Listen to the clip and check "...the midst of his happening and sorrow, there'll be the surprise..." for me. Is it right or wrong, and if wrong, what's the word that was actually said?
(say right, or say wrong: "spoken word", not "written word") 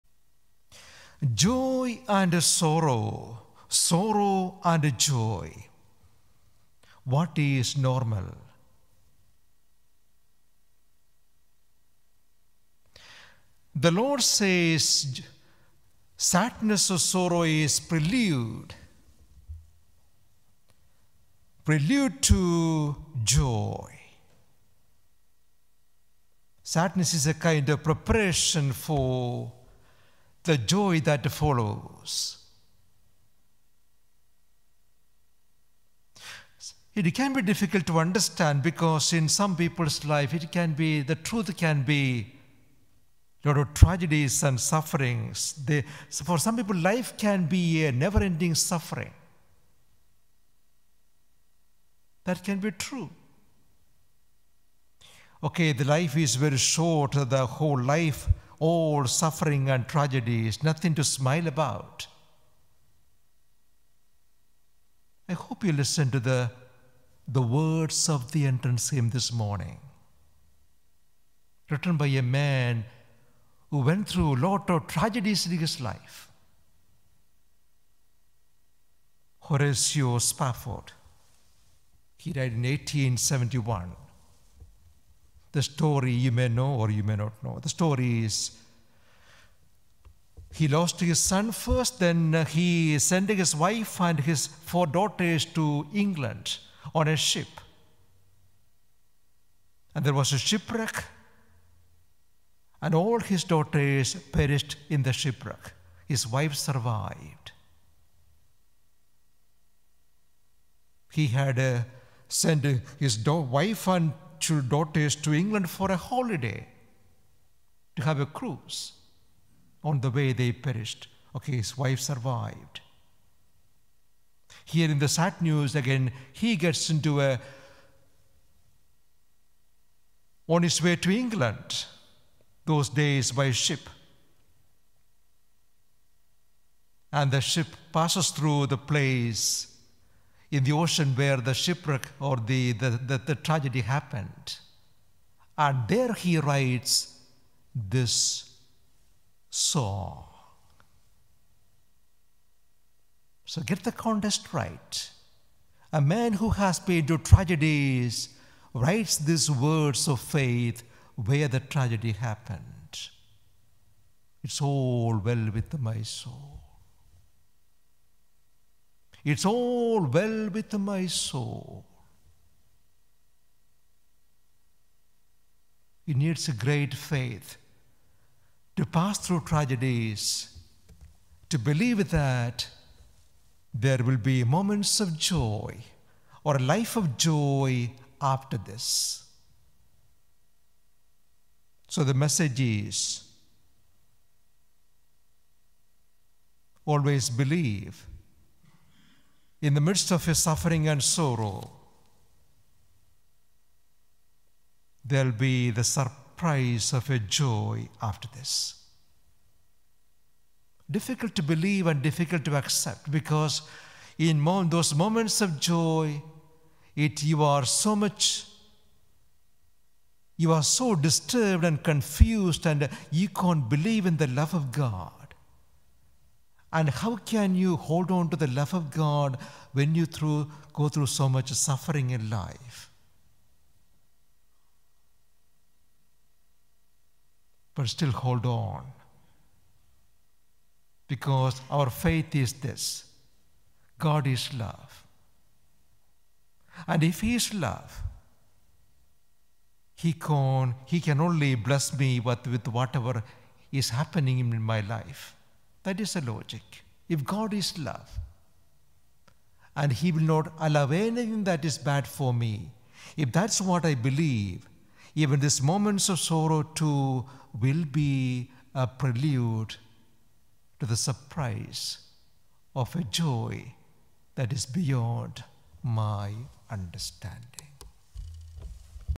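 wrong: "suffering", not "happening".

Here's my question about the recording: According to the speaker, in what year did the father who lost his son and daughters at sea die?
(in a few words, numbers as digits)
1871.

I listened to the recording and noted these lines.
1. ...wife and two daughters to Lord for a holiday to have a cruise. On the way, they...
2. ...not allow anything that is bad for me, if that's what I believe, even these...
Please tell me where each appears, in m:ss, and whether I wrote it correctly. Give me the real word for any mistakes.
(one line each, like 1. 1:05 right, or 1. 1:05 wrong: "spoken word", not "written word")
1. 1:53 wrong: "England", not "Lord"
2. 4:20 right.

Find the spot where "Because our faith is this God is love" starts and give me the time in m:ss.
4:01.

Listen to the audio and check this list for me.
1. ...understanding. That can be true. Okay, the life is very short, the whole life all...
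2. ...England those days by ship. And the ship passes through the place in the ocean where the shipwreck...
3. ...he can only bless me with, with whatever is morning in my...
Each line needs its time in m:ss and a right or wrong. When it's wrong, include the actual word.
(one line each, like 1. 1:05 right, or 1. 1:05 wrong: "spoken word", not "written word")
1. 0:48 wrong: "suffering", not "understanding"
2. 2:11 right
3. 4:10 wrong: "happening", not "morning".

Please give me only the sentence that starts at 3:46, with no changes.
And how can you hold on to the love of God when you through, go through so much suffering in life?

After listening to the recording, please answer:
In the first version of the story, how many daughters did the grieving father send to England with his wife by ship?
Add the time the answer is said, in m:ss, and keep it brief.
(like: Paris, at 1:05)
4, at 1:34.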